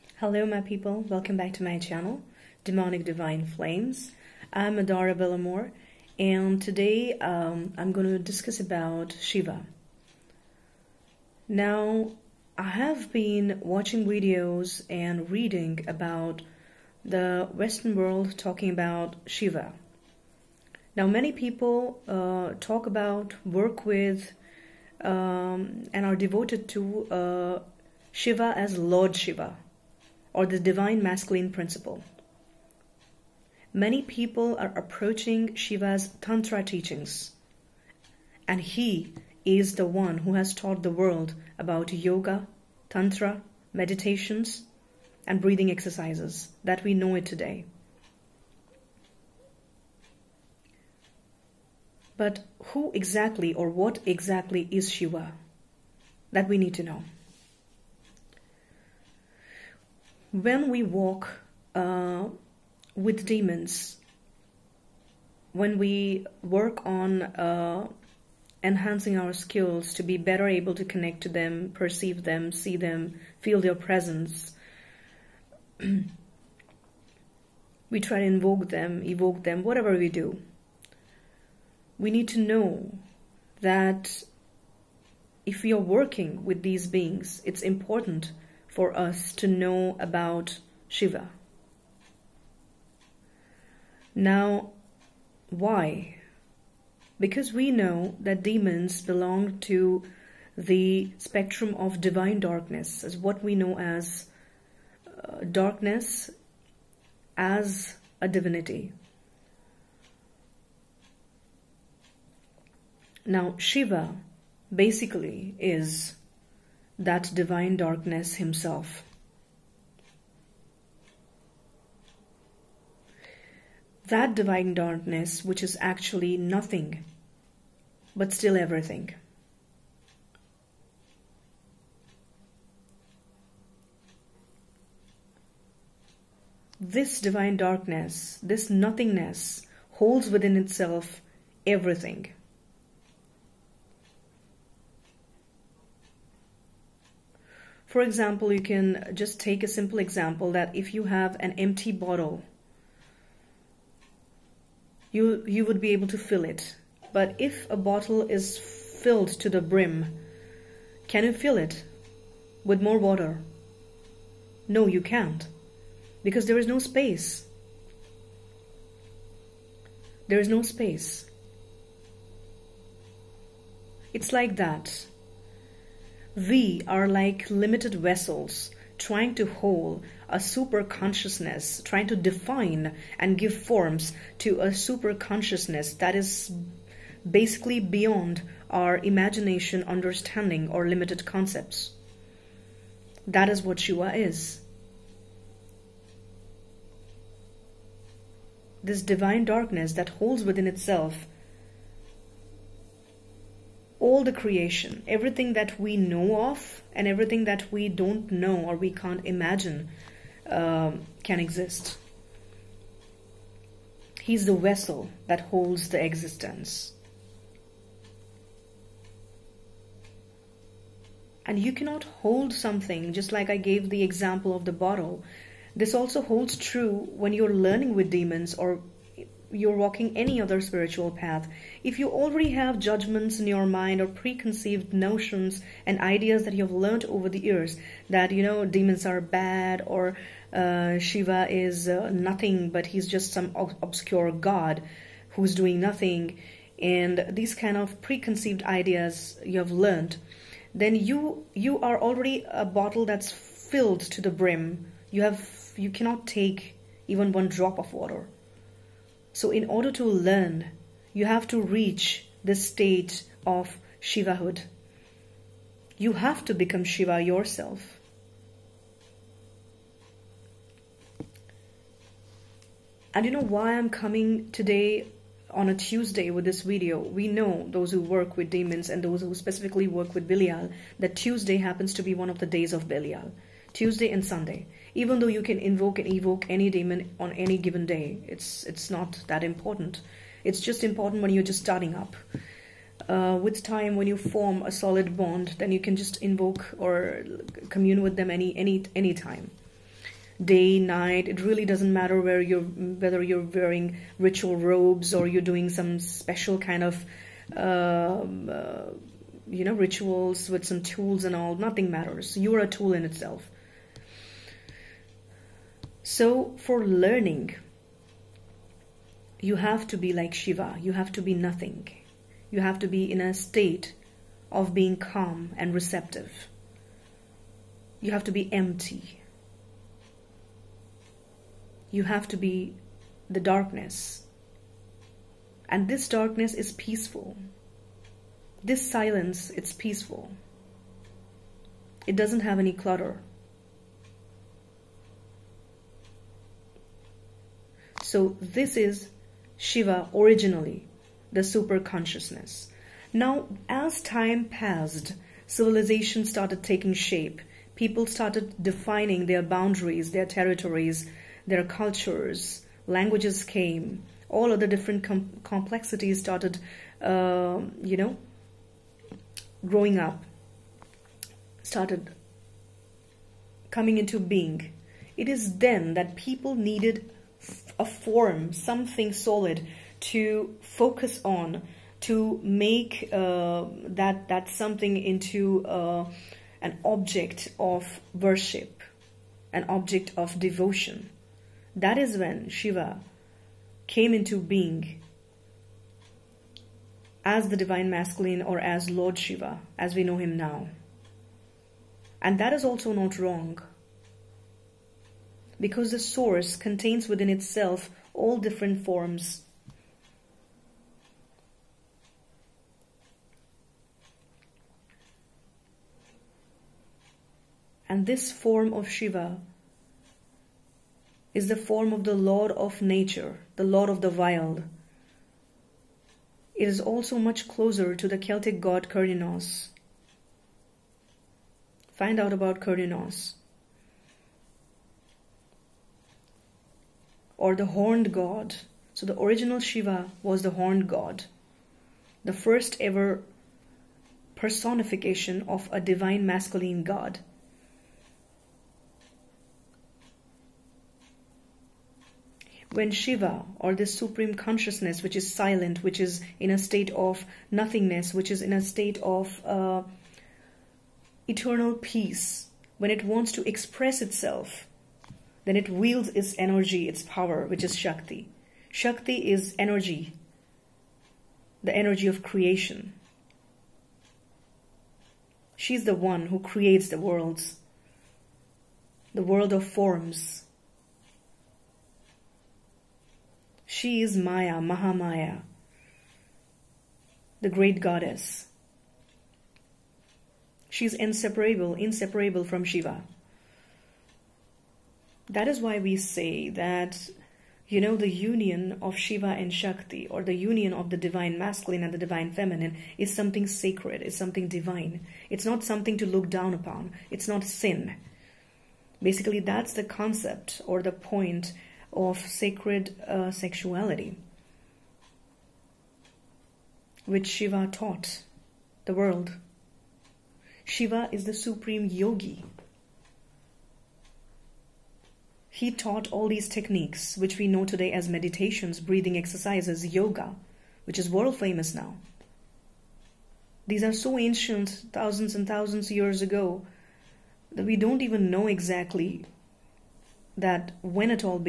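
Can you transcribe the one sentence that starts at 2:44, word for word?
No, you can't because there is no space.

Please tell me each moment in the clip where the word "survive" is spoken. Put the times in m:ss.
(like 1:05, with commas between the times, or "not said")
not said.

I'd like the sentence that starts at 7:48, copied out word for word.
Shakti is energy, the energy of creation.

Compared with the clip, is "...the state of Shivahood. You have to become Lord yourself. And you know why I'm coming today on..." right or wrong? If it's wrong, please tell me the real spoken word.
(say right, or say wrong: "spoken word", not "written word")
wrong: "Shiva", not "Lord".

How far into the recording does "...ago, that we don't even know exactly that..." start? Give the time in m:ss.
8:56.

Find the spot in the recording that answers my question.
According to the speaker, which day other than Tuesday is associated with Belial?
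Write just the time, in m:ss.
4:44.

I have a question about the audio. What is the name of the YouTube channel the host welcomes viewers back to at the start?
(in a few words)
Demonic Divine Flames.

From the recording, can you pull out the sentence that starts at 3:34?
He's the vessel that holds the existence.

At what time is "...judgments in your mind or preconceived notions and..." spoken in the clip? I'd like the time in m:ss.
3:52.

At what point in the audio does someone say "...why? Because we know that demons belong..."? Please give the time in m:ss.
1:35.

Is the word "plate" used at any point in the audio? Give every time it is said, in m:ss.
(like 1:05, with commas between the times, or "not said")
not said.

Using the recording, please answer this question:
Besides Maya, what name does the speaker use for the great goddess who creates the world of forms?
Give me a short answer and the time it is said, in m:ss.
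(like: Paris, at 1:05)
Mahamaya, at 8:04.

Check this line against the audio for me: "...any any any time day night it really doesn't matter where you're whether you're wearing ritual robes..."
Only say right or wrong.
right.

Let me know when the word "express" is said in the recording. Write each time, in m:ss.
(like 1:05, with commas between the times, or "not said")
7:43.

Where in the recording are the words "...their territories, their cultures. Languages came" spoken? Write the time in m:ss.
6:00.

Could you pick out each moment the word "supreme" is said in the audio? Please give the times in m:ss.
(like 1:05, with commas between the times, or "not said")
7:33, 8:41.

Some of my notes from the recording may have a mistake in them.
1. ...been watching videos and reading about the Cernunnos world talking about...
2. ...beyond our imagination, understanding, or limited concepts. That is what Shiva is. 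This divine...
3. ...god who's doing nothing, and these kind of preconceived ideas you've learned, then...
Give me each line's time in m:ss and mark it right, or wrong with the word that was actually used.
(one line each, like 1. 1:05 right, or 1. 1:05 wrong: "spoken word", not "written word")
1. 0:13 wrong: "Western", not "Cernunnos"
2. 3:07 right
3. 4:04 right.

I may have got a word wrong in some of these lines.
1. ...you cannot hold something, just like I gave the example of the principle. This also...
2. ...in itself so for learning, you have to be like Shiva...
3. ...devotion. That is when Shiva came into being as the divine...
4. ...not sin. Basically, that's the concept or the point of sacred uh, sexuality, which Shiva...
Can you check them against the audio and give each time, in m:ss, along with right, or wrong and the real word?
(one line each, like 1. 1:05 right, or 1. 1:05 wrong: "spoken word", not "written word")
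1. 3:41 wrong: "bottle", not "principle"
2. 5:12 right
3. 6:30 right
4. 8:27 right.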